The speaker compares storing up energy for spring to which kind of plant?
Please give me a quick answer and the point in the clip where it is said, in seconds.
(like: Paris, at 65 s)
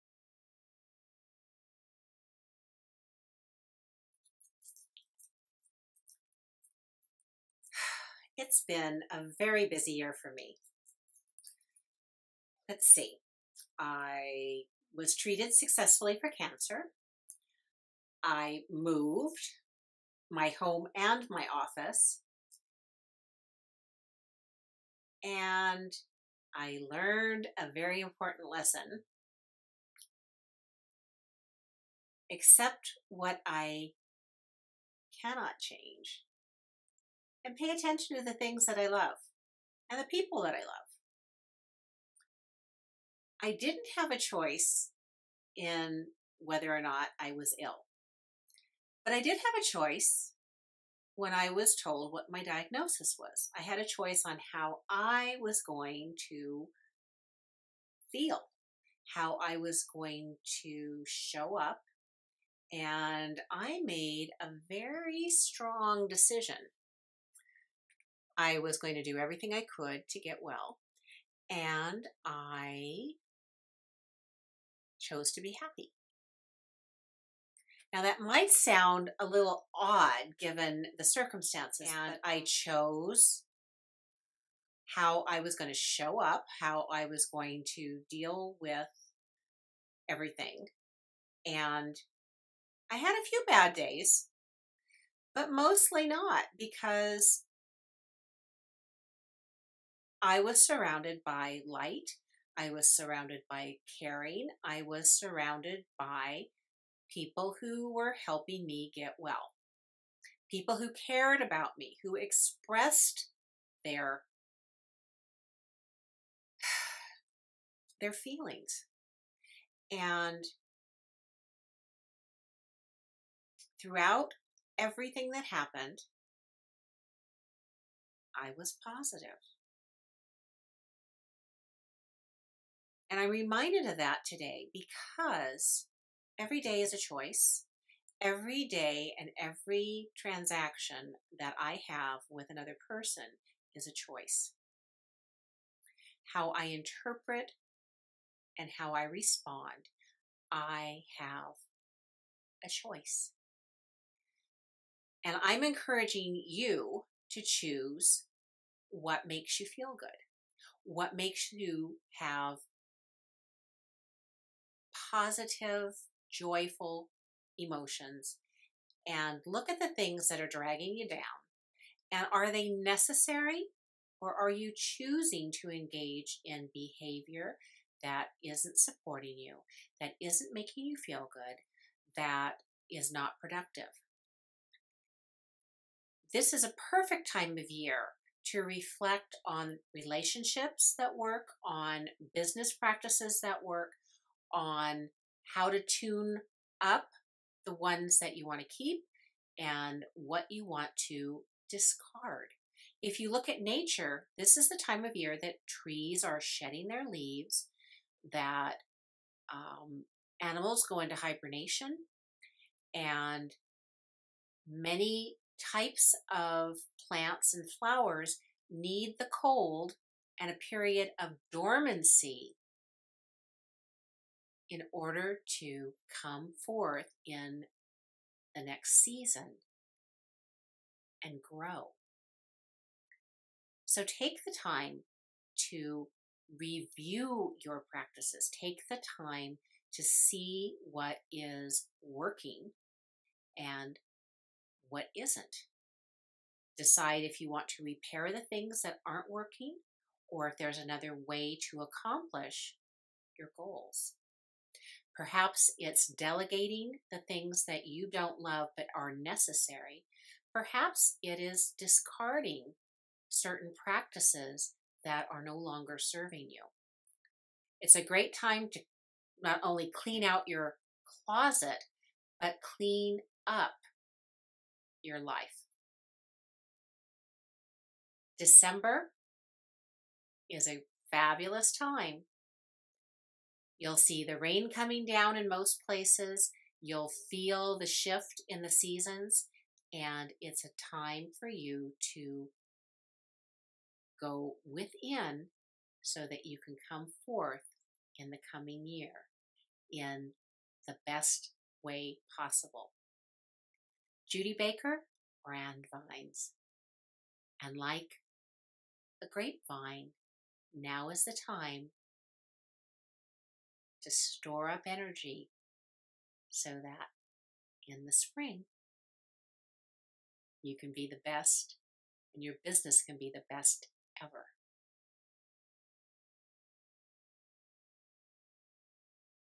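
grapevine, at 309 s.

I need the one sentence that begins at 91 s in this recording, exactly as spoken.
And I had a few bad days, but mostly not because I was surrounded by light.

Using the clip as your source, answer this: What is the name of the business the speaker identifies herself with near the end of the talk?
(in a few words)
BrandVines.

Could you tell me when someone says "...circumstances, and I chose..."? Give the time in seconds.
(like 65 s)
81 s.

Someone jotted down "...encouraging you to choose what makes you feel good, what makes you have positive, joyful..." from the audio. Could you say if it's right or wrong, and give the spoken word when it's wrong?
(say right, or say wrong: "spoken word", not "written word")
right.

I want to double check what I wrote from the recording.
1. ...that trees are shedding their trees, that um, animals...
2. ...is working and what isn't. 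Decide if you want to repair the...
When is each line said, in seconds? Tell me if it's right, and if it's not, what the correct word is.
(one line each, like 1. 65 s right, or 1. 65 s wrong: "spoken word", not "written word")
1. 205 s wrong: "leaves", not "trees"
2. 241 s right.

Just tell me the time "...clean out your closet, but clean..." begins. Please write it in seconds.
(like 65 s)
269 s.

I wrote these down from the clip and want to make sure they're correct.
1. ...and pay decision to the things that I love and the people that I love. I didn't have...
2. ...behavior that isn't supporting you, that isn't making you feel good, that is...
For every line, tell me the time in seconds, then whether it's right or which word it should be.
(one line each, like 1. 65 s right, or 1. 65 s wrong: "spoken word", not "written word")
1. 37 s wrong: "attention", not "decision"
2. 176 s right.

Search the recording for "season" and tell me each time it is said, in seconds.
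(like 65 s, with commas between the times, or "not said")
229 s, 288 s.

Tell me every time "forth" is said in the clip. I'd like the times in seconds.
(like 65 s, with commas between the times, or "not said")
226 s, 297 s.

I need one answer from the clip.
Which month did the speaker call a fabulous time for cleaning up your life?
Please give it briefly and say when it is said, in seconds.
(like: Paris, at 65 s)
December, at 278 s.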